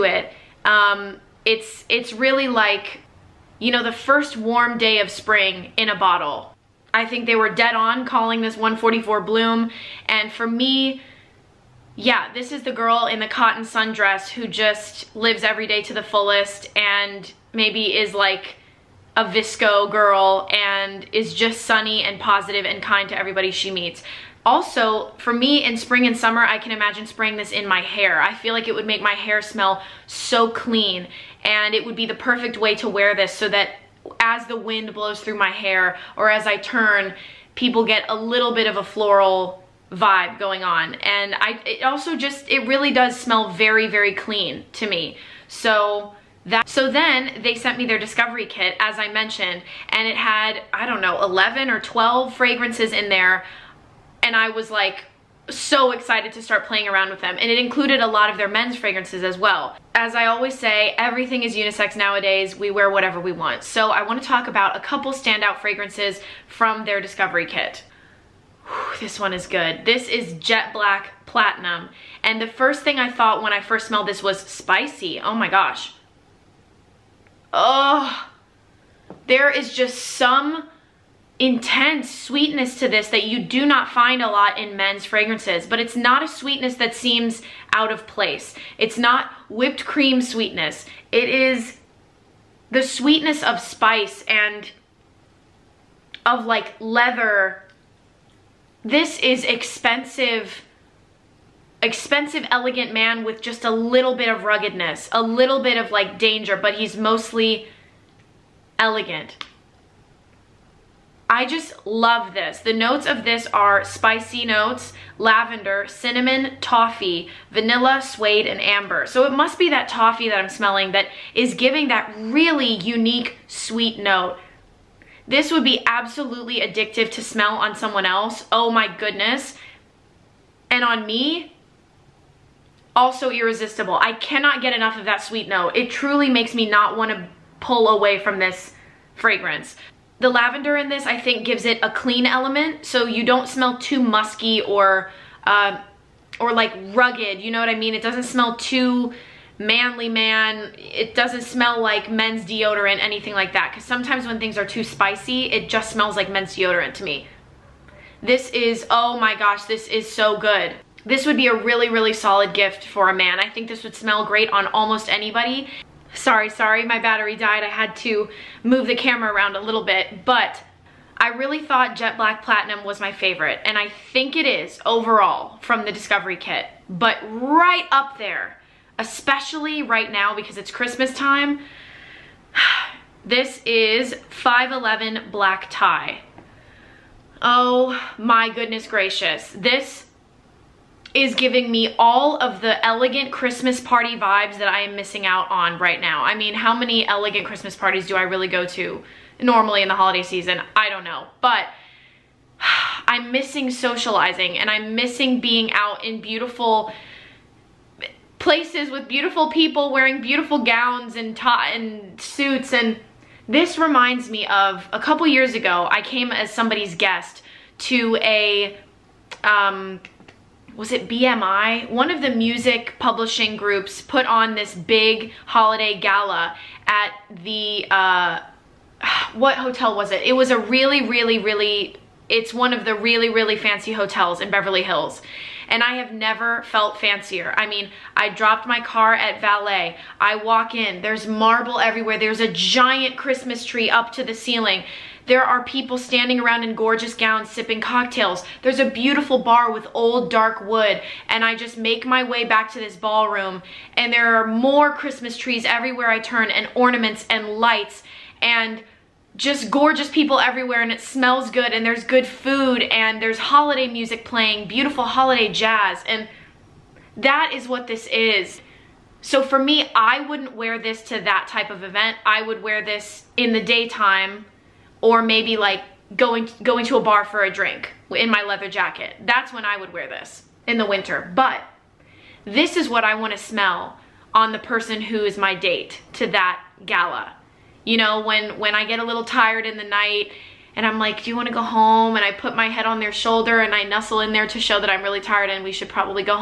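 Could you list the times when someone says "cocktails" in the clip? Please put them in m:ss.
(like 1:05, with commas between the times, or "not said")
4:07.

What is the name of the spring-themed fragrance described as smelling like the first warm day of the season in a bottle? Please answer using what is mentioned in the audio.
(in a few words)
144 Bloom.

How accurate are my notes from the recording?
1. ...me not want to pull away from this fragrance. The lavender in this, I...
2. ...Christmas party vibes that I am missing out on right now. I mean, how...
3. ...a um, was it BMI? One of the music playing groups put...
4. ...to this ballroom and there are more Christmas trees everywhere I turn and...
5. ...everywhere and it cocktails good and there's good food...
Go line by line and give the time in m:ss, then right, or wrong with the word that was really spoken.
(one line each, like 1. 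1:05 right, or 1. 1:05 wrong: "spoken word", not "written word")
1. 2:16 right
2. 3:13 right
3. 3:38 wrong: "publishing", not "playing"
4. 4:12 right
5. 4:20 wrong: "smells", not "cocktails".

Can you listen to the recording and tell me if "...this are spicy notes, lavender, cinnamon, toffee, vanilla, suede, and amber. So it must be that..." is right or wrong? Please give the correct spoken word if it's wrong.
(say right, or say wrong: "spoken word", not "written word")
right.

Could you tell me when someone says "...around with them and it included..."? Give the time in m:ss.
0:56.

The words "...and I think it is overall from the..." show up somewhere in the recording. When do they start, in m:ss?
2:53.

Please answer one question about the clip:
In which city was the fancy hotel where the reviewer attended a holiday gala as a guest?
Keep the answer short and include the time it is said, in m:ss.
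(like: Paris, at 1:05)
Beverly Hills, at 3:54.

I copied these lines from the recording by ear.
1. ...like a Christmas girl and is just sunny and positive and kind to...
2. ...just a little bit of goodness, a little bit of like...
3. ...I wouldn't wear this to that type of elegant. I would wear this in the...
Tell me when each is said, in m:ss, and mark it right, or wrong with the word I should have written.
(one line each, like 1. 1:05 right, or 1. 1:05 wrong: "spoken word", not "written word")
1. 0:18 wrong: "VSCO", not "Christmas"
2. 1:43 wrong: "ruggedness", not "goodness"
3. 4:29 wrong: "event", not "elegant".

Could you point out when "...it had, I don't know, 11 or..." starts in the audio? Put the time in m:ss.
0:50.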